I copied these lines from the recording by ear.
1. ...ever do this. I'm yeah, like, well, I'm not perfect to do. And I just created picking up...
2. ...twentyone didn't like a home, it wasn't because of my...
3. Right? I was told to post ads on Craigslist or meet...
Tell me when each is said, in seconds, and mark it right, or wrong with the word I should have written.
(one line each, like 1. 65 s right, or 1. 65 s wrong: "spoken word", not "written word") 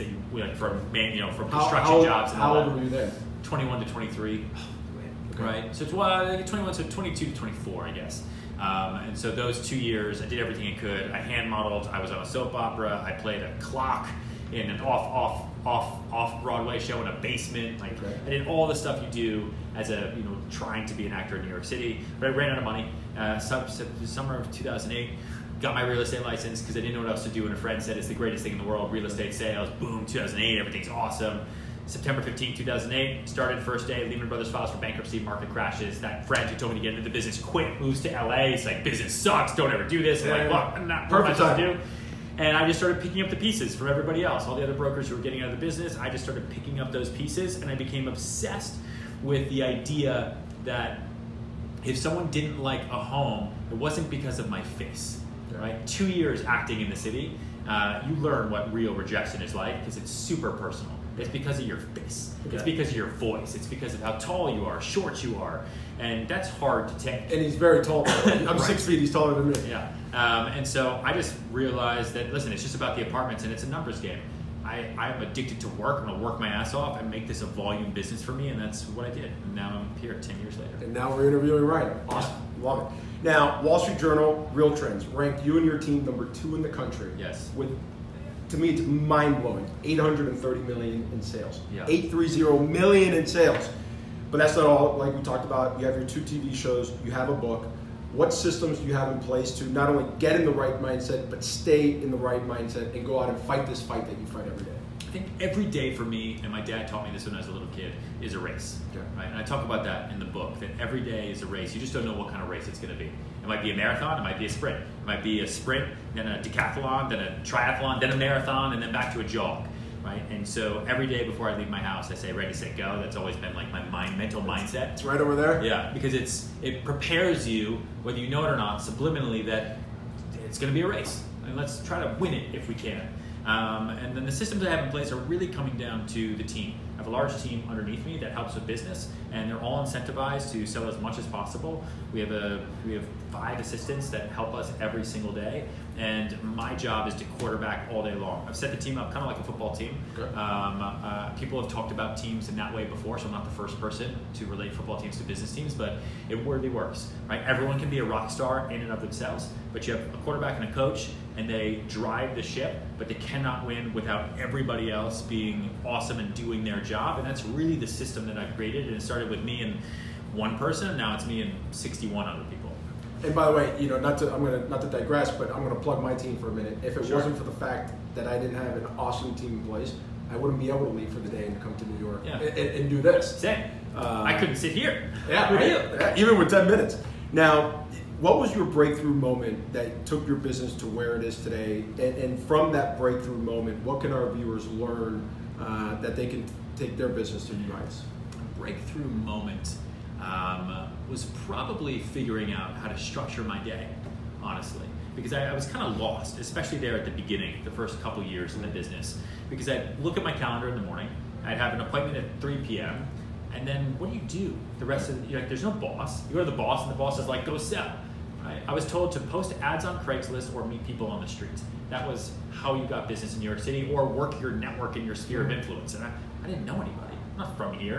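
1. 39 s wrong: "started", not "created"
2. 51 s wrong: "someone", not "twentyone"
3. 218 s right.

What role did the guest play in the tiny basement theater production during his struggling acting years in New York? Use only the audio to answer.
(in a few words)
A clock.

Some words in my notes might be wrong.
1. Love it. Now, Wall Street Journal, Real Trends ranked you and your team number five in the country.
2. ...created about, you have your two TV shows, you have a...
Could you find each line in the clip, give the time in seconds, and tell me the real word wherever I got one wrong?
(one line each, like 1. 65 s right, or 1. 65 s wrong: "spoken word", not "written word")
1. 82 s wrong: "two", not "five"
2. 95 s wrong: "talked", not "created".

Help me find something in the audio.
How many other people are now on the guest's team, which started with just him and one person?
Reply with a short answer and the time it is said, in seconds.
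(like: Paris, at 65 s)
61, at 171 s.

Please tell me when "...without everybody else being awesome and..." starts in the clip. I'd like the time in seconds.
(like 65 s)
163 s.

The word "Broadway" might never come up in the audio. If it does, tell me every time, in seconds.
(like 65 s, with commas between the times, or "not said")
16 s.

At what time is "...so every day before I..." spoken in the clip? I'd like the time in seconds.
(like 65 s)
120 s.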